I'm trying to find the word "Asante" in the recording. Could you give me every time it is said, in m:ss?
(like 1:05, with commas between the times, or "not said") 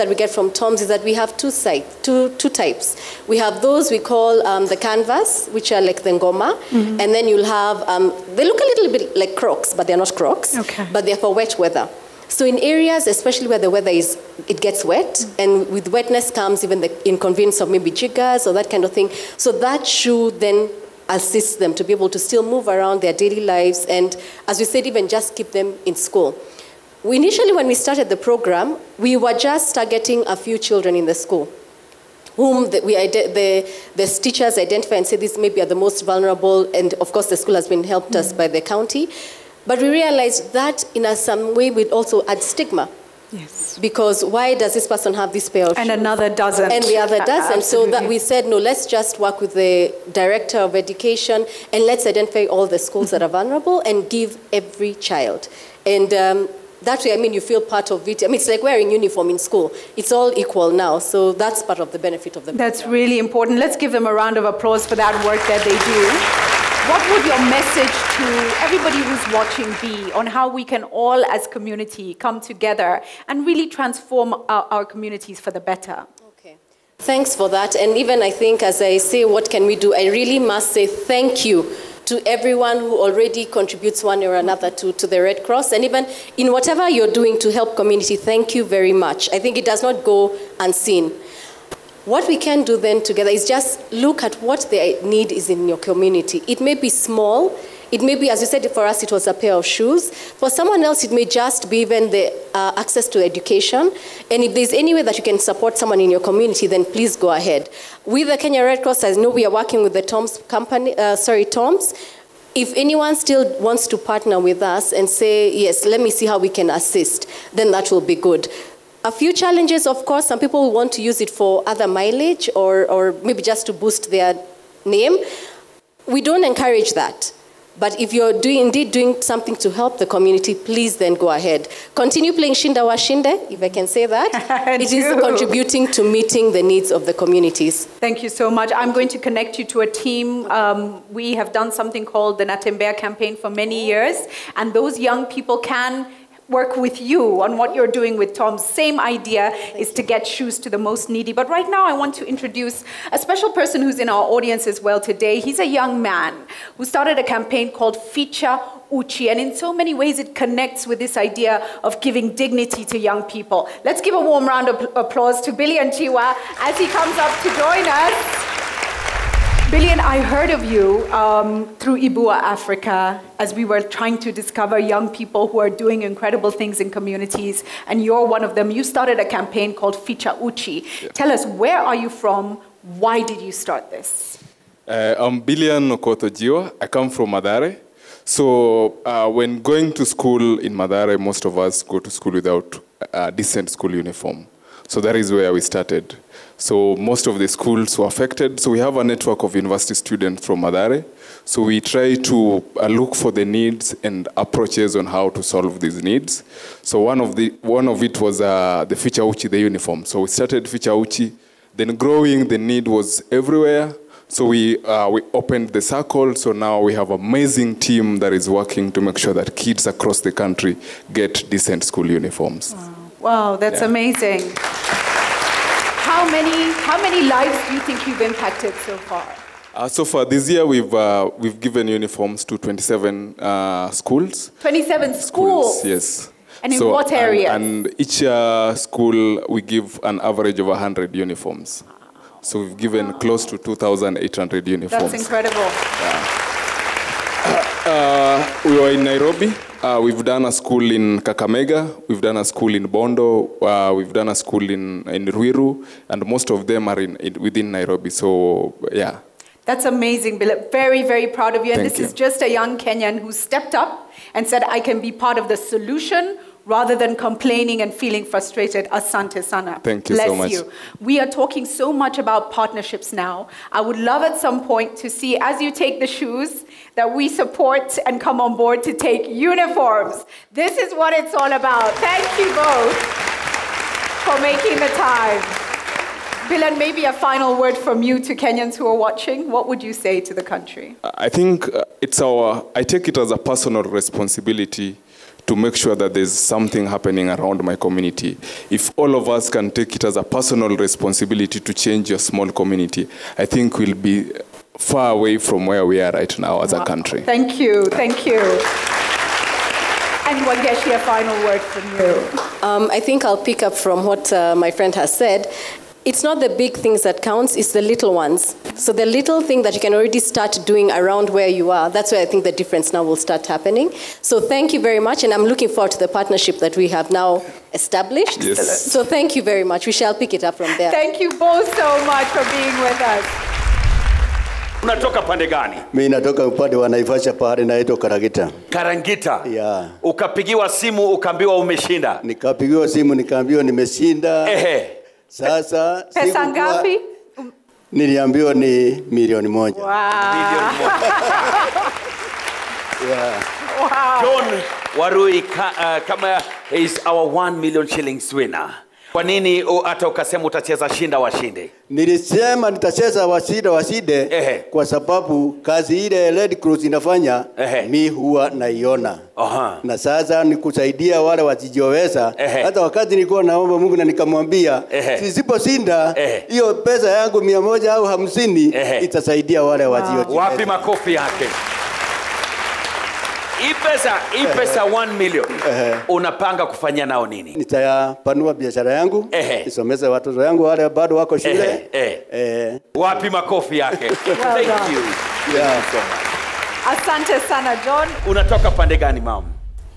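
4:28, 6:36.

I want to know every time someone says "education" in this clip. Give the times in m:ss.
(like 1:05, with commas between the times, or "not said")
0:50, 1:43.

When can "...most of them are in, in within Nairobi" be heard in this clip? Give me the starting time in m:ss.
4:16.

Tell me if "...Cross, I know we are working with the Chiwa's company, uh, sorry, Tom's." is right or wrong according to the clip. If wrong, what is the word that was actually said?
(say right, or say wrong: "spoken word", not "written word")
wrong: "Tom", not "Chiwa".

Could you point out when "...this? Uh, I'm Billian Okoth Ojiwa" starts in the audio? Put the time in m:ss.
3:03.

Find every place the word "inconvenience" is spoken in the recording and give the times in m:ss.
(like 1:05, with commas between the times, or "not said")
0:17.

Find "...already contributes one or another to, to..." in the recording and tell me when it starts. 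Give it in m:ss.
1:22.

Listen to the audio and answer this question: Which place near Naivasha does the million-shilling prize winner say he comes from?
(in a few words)
Karagita.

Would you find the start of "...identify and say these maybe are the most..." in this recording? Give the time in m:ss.
0:34.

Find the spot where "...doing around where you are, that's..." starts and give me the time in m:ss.
5:20.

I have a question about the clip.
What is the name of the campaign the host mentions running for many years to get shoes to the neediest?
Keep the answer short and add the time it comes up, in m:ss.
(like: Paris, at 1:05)
Natembea campaign, at 2:22.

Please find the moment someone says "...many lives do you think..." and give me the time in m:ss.
3:47.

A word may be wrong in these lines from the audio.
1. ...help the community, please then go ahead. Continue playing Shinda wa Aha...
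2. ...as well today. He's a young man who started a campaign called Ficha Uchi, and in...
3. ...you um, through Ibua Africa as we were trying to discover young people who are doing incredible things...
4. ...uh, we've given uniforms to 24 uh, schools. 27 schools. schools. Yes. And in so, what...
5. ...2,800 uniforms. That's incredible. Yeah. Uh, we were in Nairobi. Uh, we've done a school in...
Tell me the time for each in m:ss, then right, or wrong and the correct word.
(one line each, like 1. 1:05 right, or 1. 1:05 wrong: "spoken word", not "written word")
1. 2:09 wrong: "Shinde", not "Aha"
2. 2:34 right
3. 2:50 right
4. 3:50 wrong: "27", not "24"
5. 4:03 right.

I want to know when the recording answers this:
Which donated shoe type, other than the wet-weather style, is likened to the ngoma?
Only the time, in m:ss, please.
0:04.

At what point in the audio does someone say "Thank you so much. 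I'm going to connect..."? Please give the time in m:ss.
2:17.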